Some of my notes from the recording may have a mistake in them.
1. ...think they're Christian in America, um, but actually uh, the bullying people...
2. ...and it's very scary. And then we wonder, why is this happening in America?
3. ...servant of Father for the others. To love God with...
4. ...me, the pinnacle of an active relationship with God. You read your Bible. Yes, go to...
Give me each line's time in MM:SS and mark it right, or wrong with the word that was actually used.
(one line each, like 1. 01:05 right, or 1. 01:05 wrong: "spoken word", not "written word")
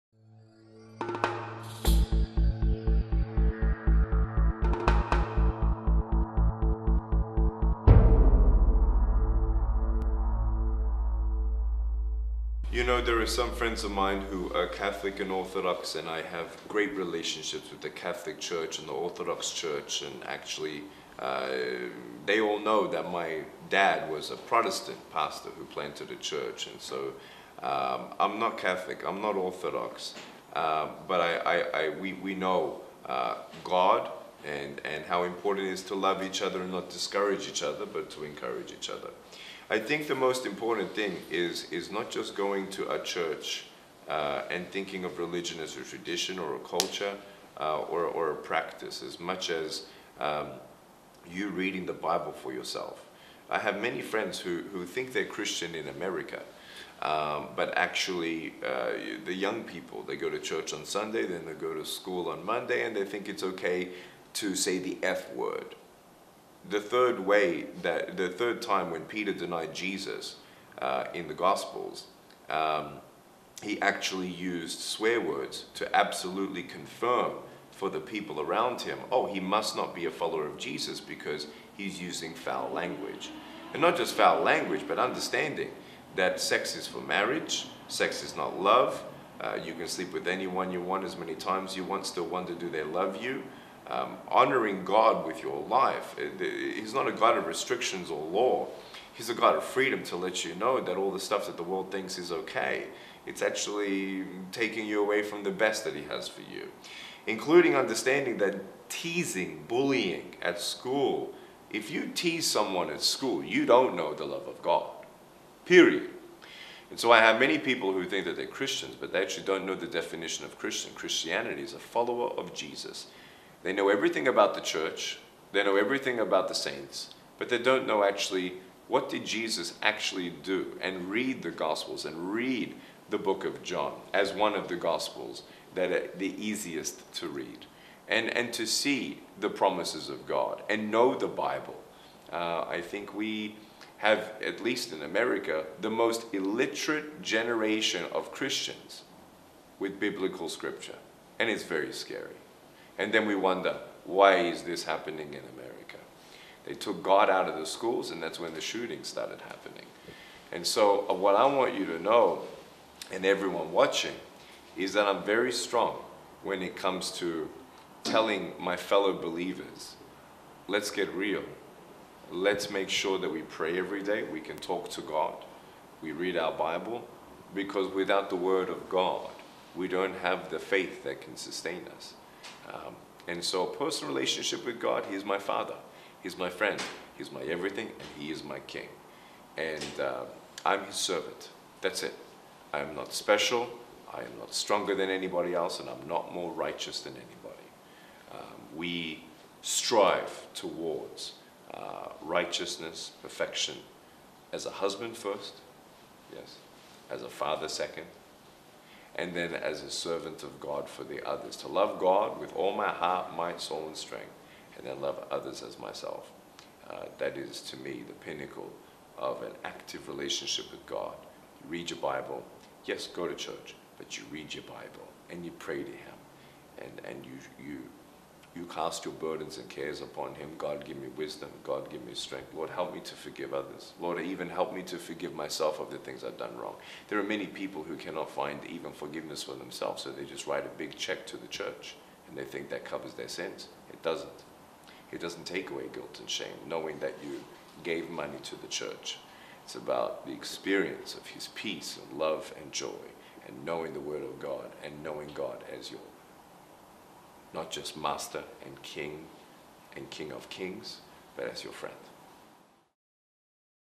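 1. 00:54 wrong: "young", not "bullying"
2. 02:31 right
3. 03:29 wrong: "God", not "Father"
4. 03:37 right.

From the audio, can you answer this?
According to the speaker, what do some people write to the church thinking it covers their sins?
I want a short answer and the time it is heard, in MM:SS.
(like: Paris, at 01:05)
A big check, at 04:00.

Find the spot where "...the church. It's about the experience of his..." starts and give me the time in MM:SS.
04:08.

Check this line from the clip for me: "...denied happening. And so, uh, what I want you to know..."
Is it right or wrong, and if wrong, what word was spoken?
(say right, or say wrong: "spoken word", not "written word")
wrong: "started", not "denied".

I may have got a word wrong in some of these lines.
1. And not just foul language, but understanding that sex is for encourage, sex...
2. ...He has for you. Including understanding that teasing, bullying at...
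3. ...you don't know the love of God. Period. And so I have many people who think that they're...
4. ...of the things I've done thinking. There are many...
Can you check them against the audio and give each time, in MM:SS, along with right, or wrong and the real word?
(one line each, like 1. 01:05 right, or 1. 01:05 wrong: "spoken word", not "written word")
1. 01:23 wrong: "marriage", not "encourage"
2. 01:45 right
3. 01:53 right
4. 03:55 wrong: "wrong", not "thinking".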